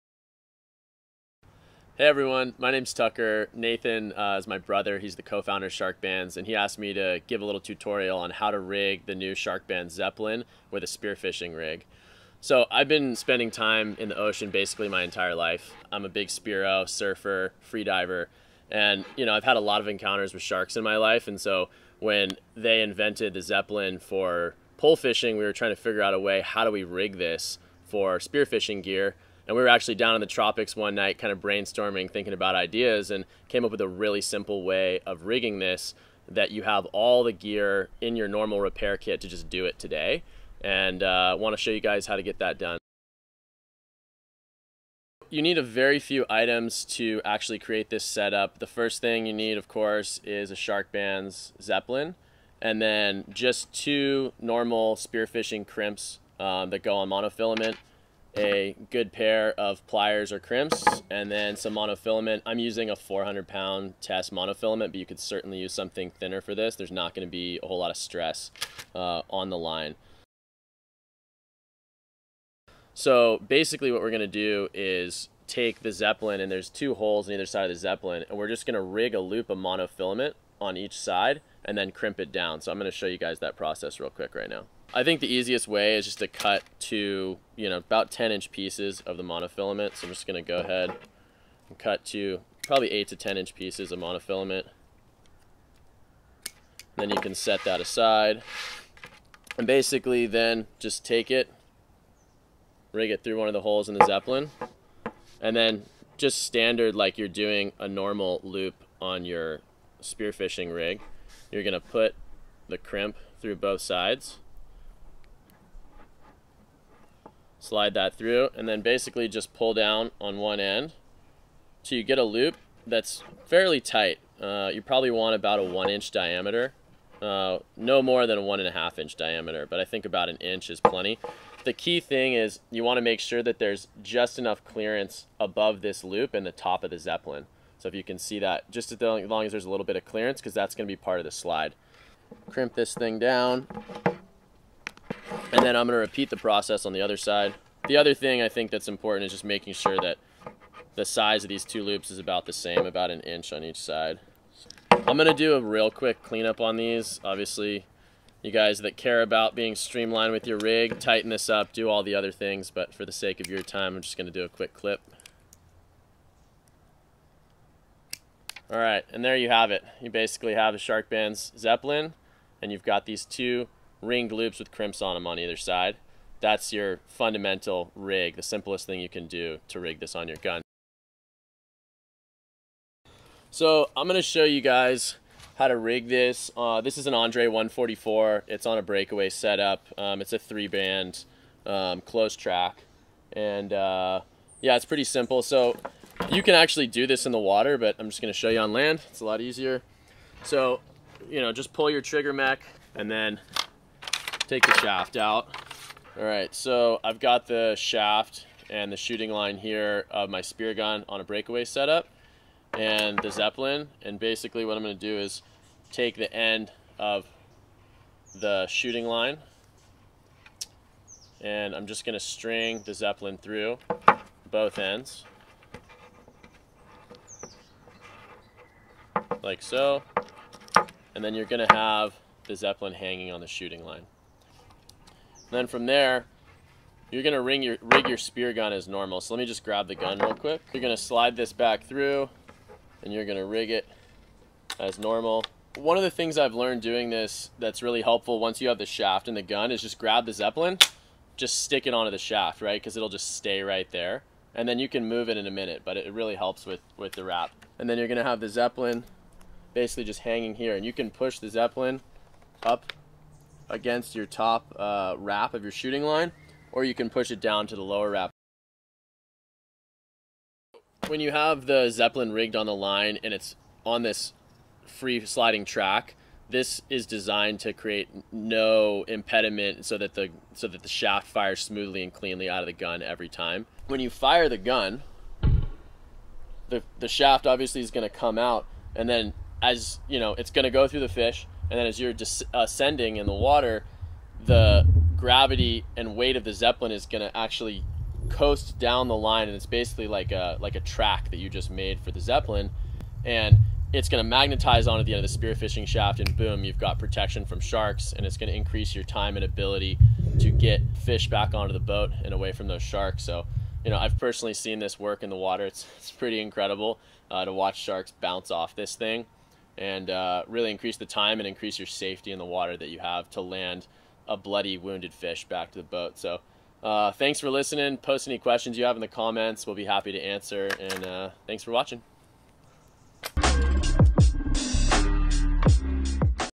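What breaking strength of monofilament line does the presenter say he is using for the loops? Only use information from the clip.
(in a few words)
400 pound.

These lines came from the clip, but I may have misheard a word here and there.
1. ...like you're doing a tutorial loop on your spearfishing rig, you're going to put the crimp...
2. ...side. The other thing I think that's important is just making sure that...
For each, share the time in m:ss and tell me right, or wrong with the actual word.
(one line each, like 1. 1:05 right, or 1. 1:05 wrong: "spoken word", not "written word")
1. 1:46 wrong: "normal", not "tutorial"
2. 2:27 right.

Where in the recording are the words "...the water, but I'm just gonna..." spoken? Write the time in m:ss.
3:17.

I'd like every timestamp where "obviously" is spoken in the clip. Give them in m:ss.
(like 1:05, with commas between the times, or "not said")
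2:37, 4:47.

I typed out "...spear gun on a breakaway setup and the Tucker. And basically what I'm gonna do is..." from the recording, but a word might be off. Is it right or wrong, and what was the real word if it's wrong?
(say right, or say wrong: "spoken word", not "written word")
wrong: "Zeppelin", not "Tucker".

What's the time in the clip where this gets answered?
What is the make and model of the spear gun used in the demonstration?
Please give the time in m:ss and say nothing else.
3:07.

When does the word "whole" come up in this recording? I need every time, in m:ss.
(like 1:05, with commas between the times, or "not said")
1:07.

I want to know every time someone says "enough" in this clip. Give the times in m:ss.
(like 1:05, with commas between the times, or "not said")
2:14.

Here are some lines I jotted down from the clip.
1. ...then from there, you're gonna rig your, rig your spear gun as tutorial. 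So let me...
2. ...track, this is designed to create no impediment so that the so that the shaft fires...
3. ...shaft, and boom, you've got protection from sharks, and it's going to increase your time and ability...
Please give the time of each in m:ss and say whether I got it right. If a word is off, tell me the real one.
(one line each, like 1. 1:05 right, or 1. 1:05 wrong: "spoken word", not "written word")
1. 3:55 wrong: "normal", not "tutorial"
2. 4:35 right
3. 5:05 right.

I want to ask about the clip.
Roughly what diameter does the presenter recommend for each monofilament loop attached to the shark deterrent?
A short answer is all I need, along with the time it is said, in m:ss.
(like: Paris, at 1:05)
1 inch, at 2:05.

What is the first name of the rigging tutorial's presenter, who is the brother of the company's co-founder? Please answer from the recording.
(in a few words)
Tucker.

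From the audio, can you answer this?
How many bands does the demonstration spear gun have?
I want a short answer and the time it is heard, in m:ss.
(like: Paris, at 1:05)
3, at 3:10.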